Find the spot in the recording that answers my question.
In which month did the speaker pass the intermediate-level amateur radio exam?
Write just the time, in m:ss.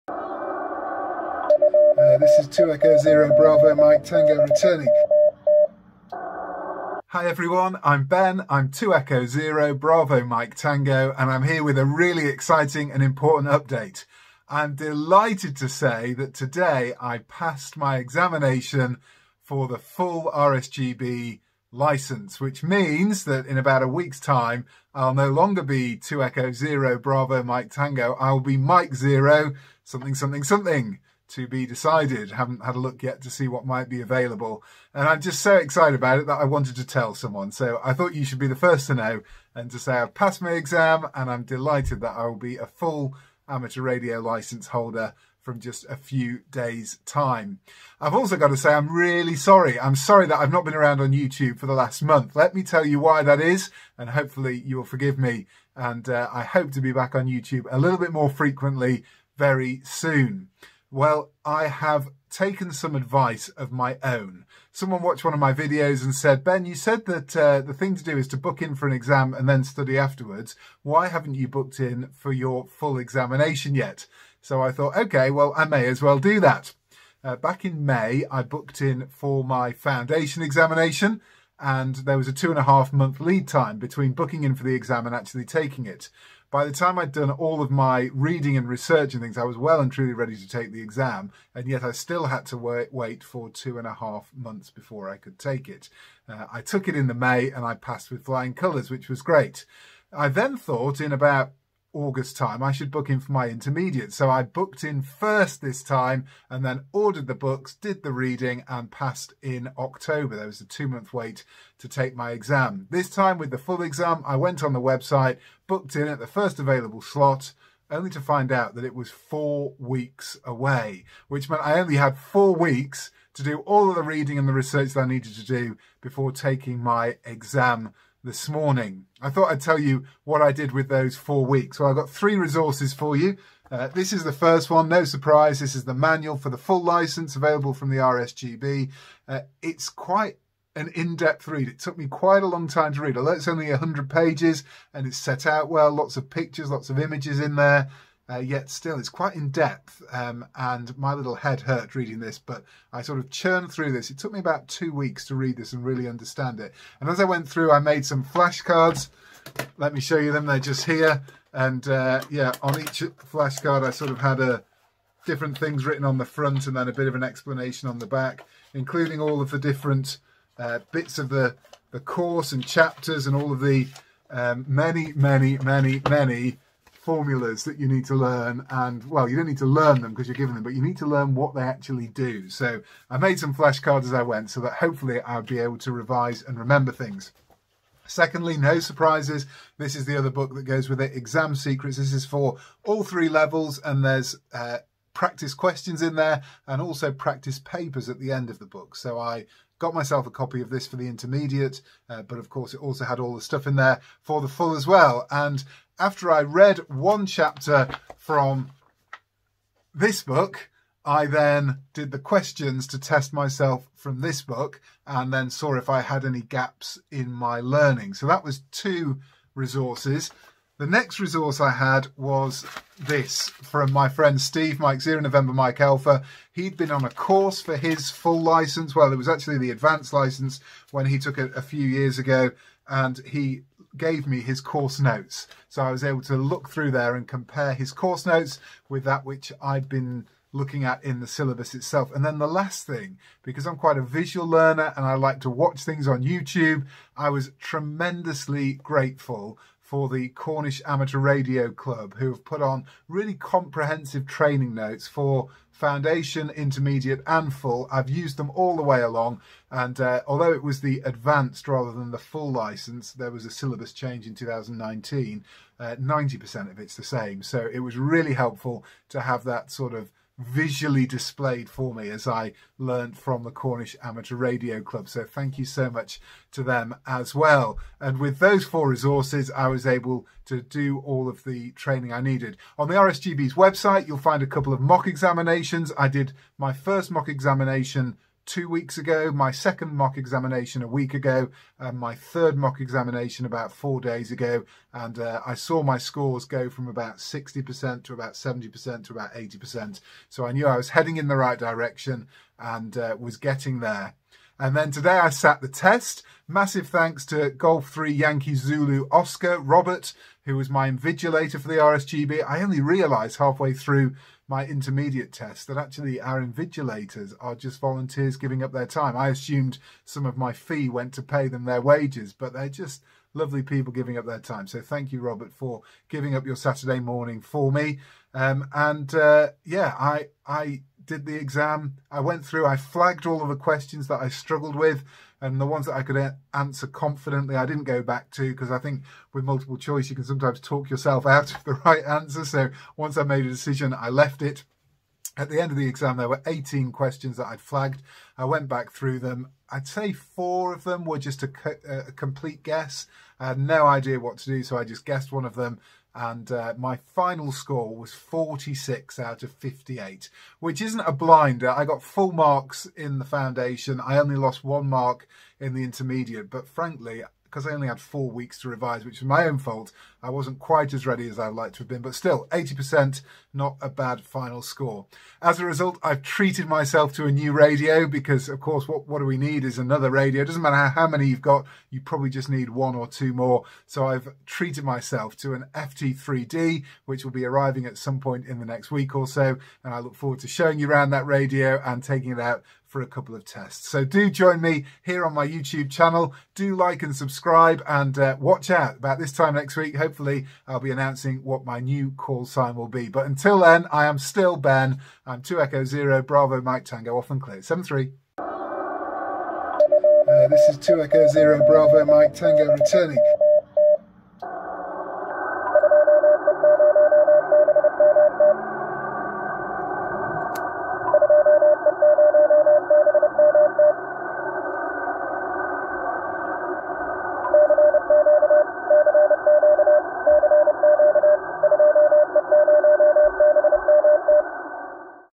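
1:49.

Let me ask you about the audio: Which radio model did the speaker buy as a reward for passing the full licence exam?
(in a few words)
FT3D.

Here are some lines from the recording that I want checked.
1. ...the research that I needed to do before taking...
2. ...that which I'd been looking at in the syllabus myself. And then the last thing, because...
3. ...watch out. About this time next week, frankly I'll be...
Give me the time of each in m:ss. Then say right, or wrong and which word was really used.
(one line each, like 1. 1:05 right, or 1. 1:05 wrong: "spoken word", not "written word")
1. 2:04 right
2. 3:59 wrong: "itself", not "myself"
3. 6:38 wrong: "hopefully", not "frankly".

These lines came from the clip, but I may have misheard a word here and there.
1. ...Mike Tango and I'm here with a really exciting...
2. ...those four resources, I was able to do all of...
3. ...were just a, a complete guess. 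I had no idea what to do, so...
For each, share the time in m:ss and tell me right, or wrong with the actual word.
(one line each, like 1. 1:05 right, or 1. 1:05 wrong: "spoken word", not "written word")
1. 0:10 right
2. 4:38 right
3. 5:51 right.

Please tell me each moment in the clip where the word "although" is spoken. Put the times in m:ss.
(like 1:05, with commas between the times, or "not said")
2:23, 4:20.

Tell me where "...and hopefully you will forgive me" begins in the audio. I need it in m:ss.
0:53.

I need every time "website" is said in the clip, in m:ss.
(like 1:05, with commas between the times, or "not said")
1:54, 4:43.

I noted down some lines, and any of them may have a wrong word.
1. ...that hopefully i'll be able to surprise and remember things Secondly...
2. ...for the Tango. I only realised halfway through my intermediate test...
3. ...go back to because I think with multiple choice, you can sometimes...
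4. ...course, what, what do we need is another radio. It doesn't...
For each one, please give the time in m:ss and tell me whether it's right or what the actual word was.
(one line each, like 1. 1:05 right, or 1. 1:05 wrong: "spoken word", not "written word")
1. 3:04 wrong: "revise", not "surprise"
2. 5:11 wrong: "RSGB", not "Tango"
3. 5:37 right
4. 6:18 right.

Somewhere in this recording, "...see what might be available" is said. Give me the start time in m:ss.
0:33.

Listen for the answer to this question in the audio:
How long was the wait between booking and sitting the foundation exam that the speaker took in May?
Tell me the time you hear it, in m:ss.
1:22.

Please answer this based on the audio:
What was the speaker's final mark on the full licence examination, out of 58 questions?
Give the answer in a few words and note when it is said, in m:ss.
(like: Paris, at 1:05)
46, at 5:58.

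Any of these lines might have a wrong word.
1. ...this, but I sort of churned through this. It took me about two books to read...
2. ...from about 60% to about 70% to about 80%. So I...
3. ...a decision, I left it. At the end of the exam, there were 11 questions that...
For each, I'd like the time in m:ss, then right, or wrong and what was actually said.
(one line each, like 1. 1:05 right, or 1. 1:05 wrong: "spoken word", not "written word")
1. 2:32 wrong: "weeks", not "books"
2. 4:56 right
3. 5:43 wrong: "18", not "11".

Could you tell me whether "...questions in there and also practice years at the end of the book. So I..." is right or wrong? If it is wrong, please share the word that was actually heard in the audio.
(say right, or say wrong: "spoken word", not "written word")
wrong: "papers", not "years".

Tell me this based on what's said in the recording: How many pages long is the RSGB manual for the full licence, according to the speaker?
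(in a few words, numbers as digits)
100.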